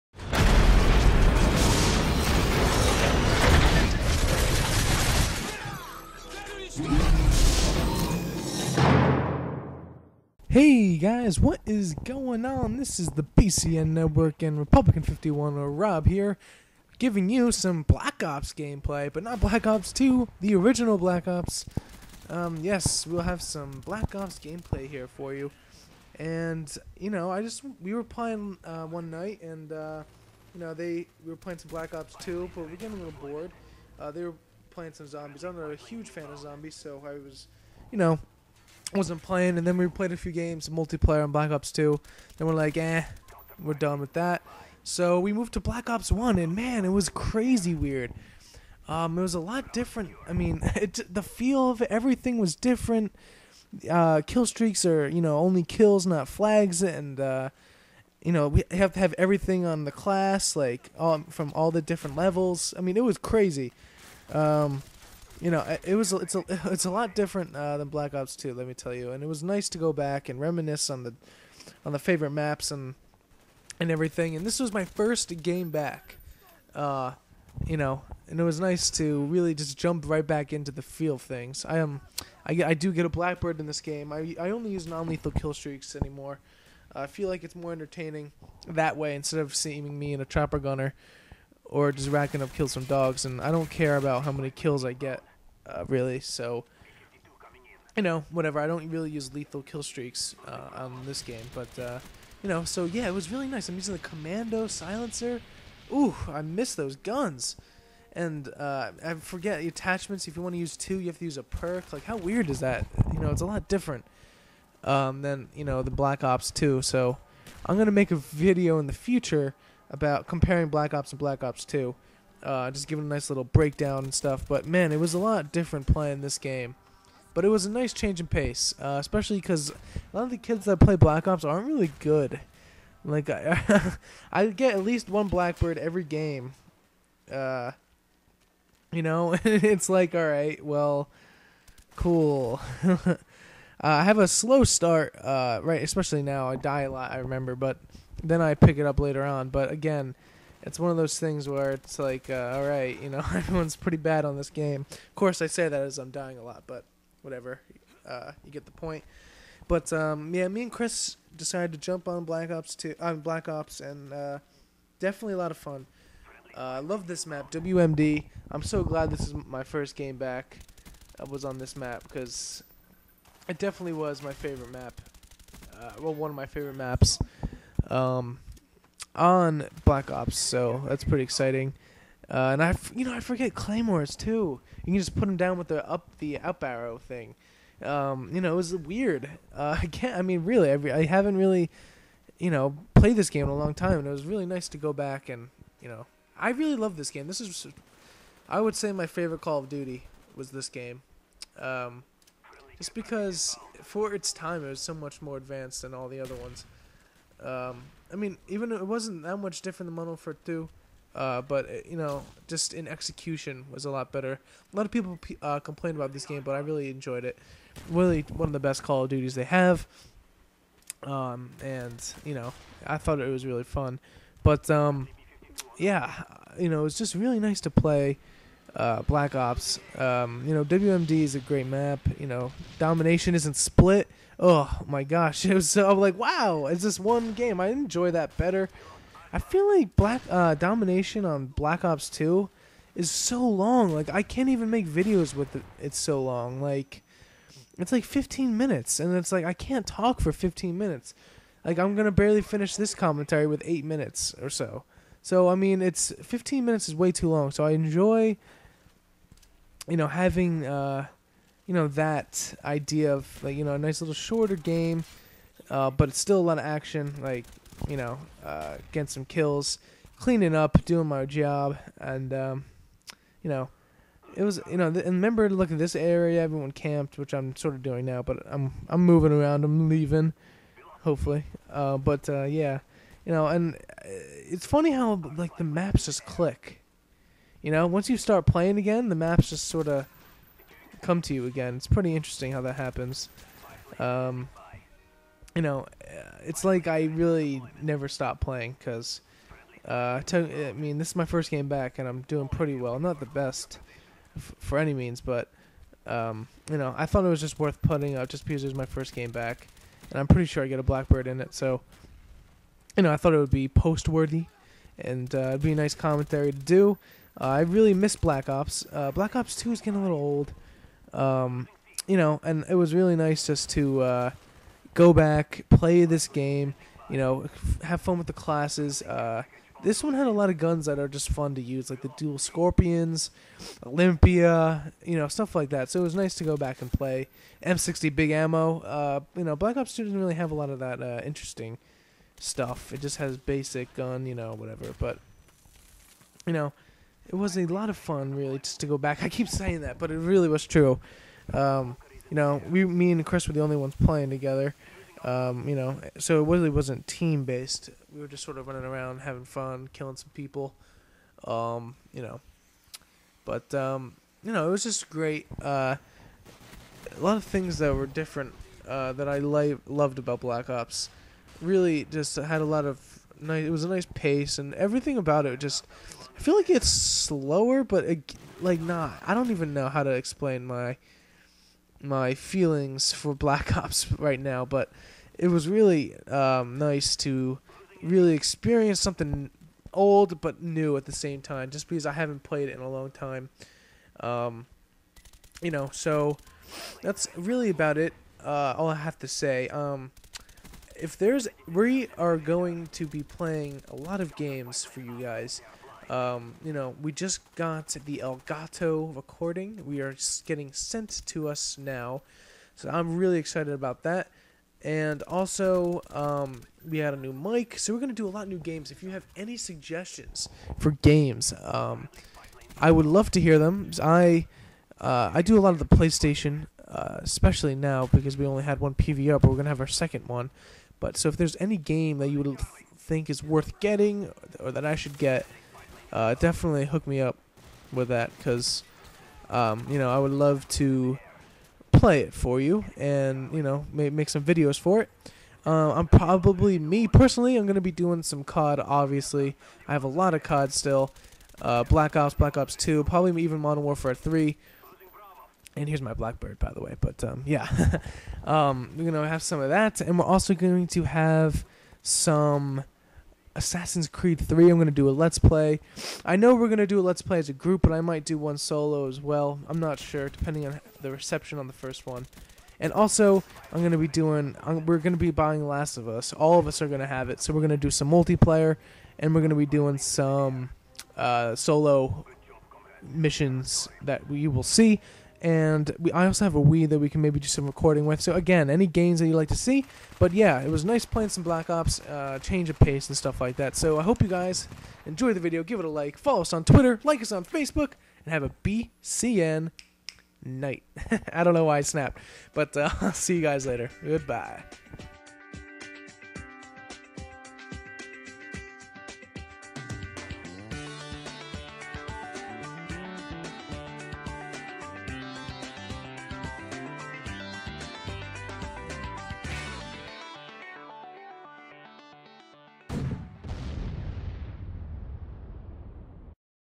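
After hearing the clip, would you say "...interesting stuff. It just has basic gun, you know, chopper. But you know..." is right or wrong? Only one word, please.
wrong.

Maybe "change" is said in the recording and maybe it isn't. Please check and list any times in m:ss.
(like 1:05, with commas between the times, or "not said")
2:07, 8:12.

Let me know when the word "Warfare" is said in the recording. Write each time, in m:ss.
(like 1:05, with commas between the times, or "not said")
3:30, 7:33.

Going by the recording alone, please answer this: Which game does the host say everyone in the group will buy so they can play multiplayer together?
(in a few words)
Last of Us.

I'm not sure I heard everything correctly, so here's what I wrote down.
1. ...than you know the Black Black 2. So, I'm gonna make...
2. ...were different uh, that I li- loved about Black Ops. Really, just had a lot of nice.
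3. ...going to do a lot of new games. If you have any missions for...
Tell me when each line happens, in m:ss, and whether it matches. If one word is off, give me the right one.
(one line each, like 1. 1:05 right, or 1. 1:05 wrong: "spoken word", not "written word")
1. 1:55 wrong: "Ops", not "Black"
2. 6:07 right
3. 6:57 wrong: "suggestions", not "missions".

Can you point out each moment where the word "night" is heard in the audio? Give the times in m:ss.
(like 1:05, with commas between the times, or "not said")
0:29, 8:20.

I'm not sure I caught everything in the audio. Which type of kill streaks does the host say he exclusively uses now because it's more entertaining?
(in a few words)
non lethal.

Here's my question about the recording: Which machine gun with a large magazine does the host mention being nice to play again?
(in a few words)
M60.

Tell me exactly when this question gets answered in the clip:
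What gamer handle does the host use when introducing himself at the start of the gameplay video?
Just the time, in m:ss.
0:14.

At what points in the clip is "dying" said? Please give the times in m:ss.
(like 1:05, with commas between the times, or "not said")
2:36.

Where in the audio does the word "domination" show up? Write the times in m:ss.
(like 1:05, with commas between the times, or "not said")
3:52, 4:00.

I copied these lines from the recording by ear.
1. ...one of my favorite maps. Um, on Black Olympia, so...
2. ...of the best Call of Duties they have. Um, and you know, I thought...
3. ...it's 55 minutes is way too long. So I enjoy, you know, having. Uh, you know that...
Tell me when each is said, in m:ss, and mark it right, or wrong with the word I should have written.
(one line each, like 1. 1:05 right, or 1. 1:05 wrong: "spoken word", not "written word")
1. 2:56 wrong: "Ops", not "Olympia"
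2. 3:38 right
3. 4:15 wrong: "15", not "55".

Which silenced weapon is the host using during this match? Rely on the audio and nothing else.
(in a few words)
commando.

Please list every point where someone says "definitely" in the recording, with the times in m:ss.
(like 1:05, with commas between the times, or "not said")
2:44, 2:53, 7:16.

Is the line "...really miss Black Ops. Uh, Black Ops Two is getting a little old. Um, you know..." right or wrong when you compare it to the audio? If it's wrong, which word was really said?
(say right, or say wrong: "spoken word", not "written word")
right.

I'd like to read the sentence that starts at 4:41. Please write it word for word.
Uh, but uh, yeah, you know, and uh, it's funny how like the maps just click.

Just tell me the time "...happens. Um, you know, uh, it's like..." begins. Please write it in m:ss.
4:52.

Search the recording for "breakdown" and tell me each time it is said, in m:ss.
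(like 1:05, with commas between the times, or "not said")
2:03.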